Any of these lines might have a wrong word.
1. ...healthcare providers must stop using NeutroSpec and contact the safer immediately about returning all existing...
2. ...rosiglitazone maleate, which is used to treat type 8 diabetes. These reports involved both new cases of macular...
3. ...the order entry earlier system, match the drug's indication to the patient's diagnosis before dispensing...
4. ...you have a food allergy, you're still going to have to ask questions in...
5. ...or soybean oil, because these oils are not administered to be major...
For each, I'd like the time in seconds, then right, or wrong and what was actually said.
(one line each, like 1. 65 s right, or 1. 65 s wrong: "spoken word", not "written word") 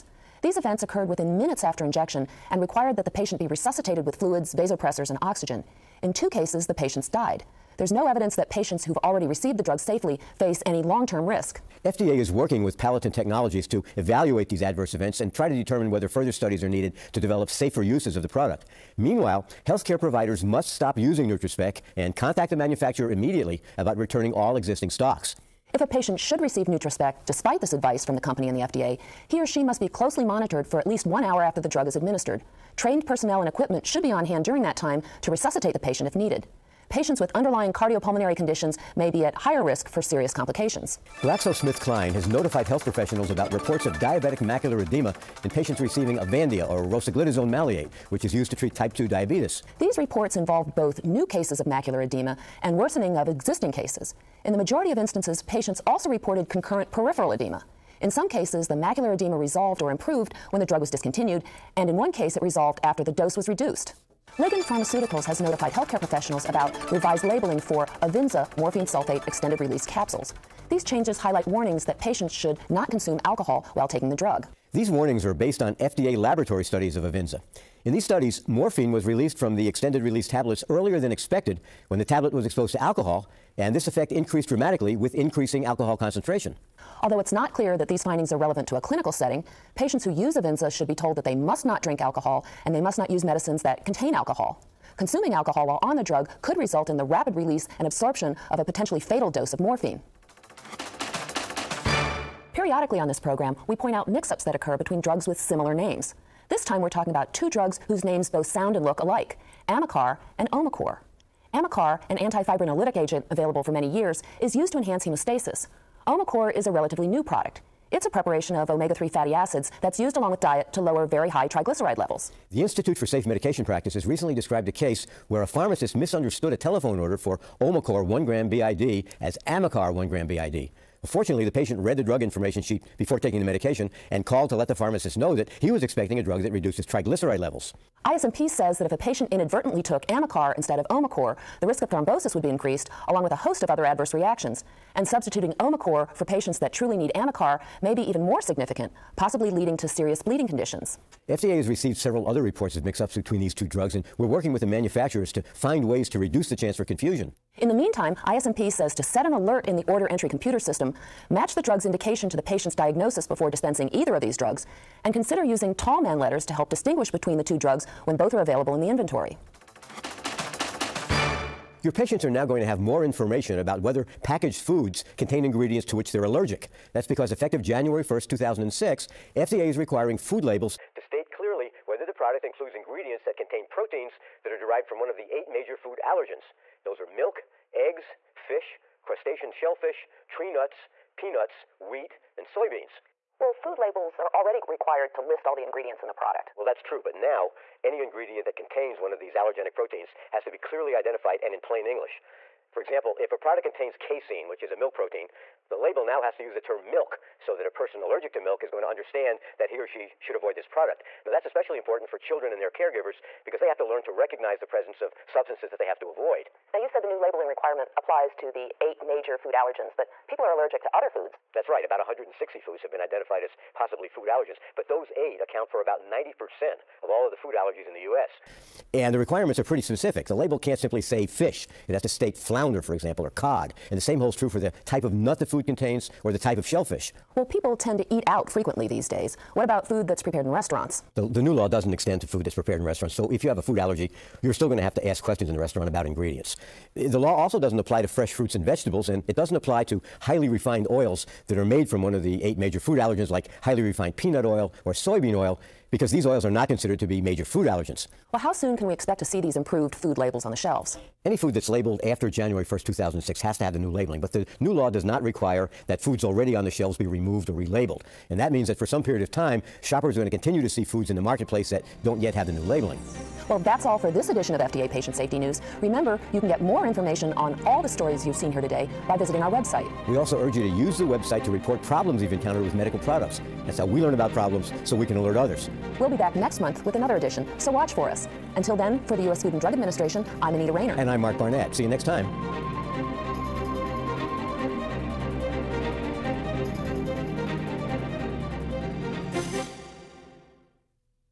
1. 19 s wrong: "manufacturer", not "safer"
2. 46 s wrong: "2", not "8"
3. 159 s wrong: "computer", not "earlier"
4. 243 s right
5. 254 s wrong: "considered", not "administered".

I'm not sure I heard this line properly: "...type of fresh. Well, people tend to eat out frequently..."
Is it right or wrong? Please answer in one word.
wrong.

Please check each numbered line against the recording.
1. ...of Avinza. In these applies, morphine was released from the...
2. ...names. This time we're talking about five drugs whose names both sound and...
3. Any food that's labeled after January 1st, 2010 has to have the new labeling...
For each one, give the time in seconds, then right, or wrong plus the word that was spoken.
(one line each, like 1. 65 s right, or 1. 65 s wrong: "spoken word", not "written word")
1. 76 s wrong: "studies", not "applies"
2. 105 s wrong: "two", not "five"
3. 261 s wrong: "2006", not "2010".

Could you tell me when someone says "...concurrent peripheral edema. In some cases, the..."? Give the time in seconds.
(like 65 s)
56 s.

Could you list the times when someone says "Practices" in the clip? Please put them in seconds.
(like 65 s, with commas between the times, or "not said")
123 s.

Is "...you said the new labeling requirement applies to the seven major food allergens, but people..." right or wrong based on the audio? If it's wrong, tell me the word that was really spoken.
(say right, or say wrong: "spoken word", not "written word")
wrong: "eight", not "seven".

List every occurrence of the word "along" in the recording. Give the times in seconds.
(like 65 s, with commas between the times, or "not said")
120 s, 143 s.